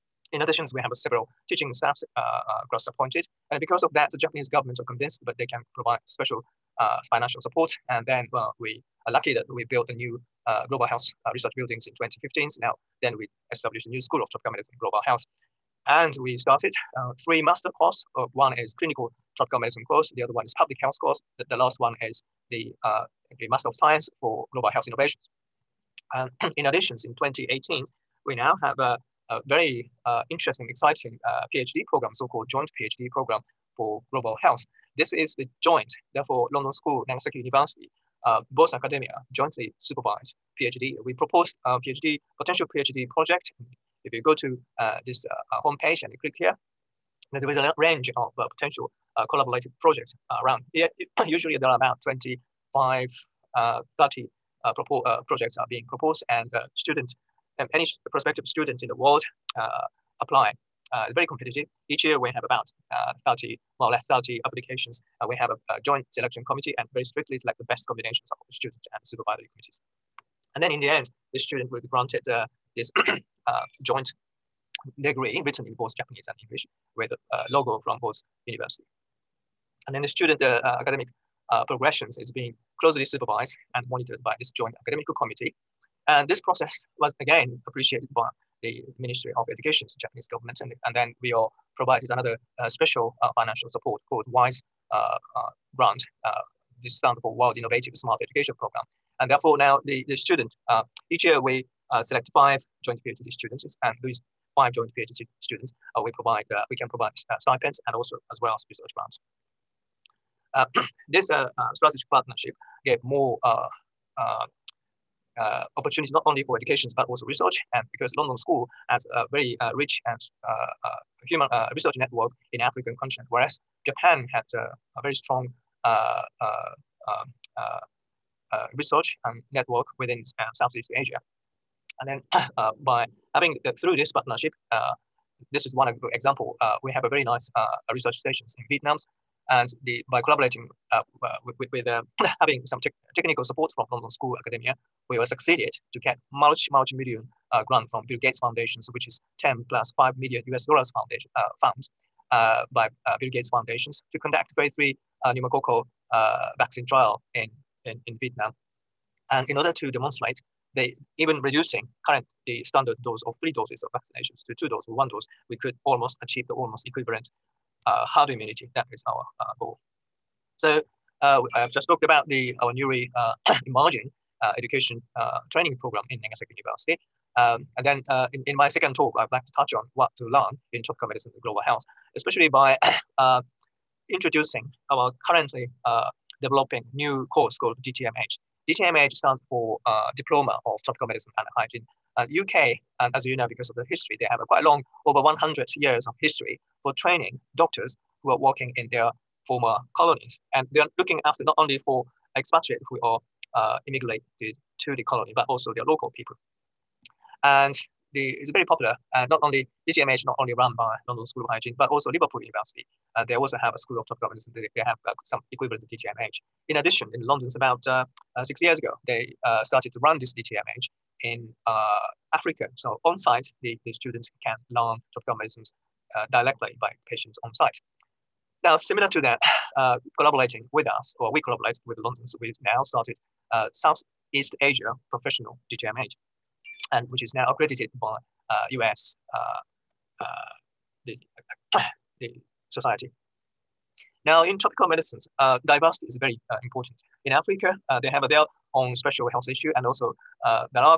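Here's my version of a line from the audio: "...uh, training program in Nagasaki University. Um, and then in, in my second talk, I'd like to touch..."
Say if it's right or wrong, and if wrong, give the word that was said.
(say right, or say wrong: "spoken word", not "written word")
right.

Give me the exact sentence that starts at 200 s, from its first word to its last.
And they are looking after not only for expatriate who are uh, immigrated to the colony, but also the local people.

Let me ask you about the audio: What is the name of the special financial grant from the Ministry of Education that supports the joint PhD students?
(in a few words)
WISE.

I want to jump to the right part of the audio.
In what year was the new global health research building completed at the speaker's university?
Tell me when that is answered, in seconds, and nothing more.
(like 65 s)
11 s.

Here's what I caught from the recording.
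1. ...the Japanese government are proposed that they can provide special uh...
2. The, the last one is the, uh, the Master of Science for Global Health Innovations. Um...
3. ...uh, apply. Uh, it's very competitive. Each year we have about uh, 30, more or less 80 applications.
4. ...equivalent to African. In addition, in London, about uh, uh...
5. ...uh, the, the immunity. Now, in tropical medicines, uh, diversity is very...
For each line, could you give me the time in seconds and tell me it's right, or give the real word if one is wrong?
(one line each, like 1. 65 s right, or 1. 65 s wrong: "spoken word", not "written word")
1. 4 s wrong: "convinced", not "proposed"
2. 21 s right
3. 59 s wrong: "30", not "80"
4. 215 s wrong: "DTMH", not "African"
5. 240 s wrong: "society", not "immunity".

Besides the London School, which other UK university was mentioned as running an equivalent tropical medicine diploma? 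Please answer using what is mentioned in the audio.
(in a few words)
Liverpool University.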